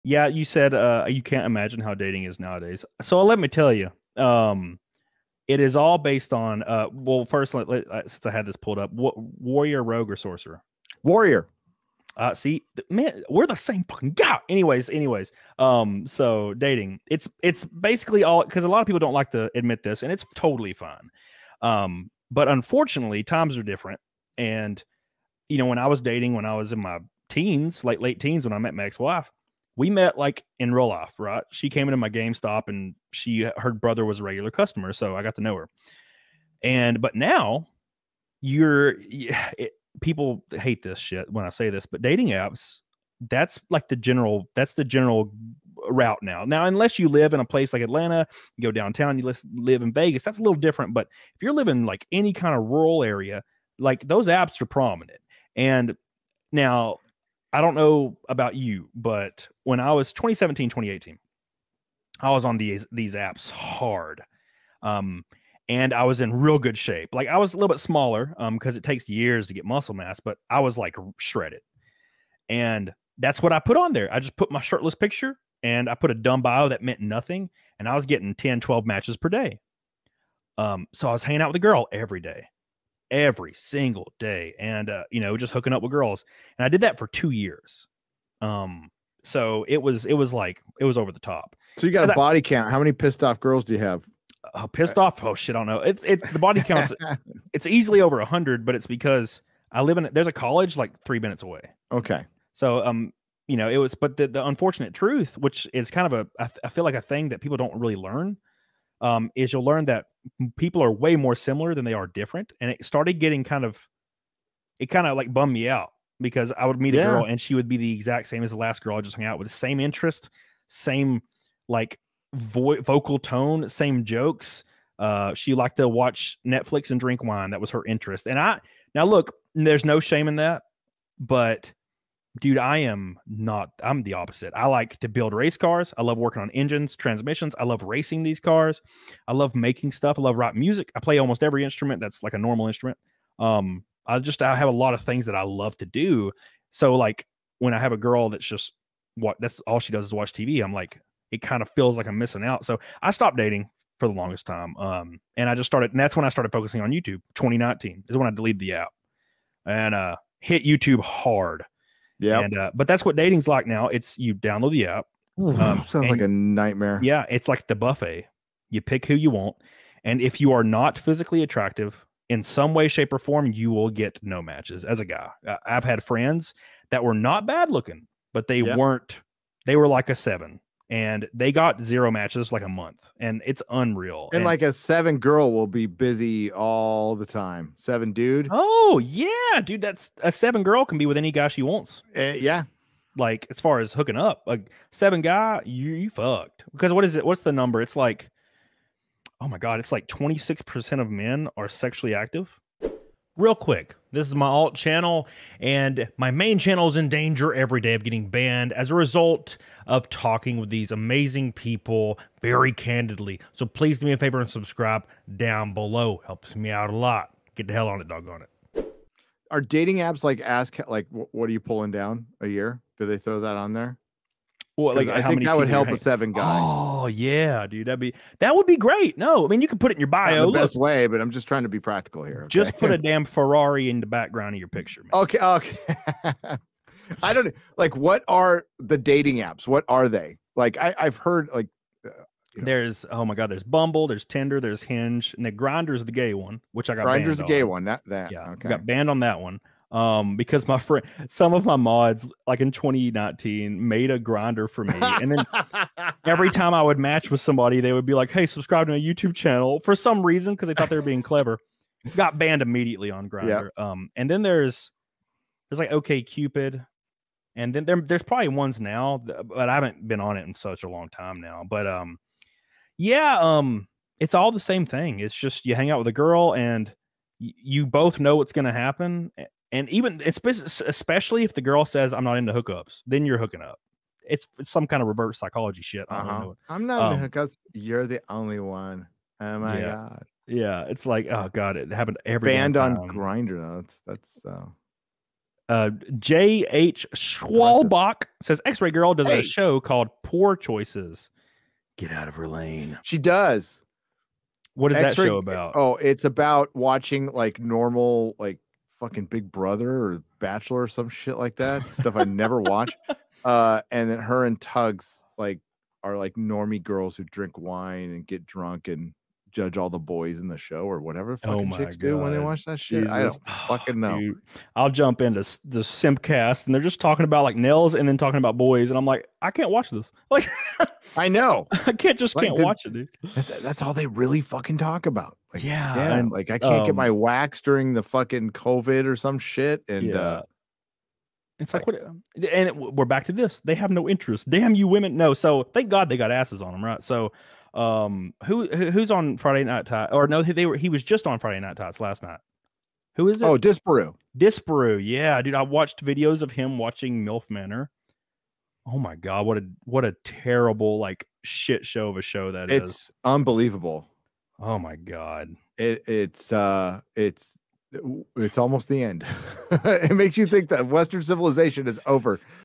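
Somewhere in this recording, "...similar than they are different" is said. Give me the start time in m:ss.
1:51.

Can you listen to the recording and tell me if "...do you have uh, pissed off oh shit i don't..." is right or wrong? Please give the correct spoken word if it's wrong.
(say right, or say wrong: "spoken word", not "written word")
right.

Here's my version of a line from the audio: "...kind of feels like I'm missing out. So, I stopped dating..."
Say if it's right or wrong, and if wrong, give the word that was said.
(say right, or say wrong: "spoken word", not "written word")
right.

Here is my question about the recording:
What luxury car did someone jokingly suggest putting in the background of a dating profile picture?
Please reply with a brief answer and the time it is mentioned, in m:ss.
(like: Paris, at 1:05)
Ferrari, at 3:53.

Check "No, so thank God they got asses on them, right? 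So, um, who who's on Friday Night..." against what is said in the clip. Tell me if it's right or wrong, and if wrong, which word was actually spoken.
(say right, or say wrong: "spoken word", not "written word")
right.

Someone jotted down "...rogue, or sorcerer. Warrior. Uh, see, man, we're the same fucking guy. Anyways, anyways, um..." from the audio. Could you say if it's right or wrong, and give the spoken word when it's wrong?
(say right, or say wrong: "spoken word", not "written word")
right.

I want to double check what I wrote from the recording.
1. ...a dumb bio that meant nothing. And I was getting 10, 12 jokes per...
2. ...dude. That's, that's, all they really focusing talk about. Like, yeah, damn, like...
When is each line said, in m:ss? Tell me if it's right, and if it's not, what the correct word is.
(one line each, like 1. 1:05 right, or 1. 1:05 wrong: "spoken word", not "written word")
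1. 1:16 wrong: "matches", not "jokes"
2. 5:32 wrong: "fucking", not "focusing".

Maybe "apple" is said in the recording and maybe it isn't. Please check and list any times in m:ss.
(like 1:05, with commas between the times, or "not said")
not said.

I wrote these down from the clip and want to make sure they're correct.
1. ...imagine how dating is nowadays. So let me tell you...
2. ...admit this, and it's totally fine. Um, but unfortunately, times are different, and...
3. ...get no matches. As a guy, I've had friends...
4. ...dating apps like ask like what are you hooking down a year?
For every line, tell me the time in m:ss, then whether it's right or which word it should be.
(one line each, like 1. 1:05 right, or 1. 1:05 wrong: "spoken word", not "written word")
1. 0:01 right
2. 0:19 right
3. 2:53 right
4. 3:39 wrong: "pulling", not "hooking".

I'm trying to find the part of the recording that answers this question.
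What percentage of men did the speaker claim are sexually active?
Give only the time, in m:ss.
3:20.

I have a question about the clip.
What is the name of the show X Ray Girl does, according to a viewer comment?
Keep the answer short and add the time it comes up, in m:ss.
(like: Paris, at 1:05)
Poor Choices, at 5:00.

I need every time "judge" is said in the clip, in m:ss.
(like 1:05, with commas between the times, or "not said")
5:19.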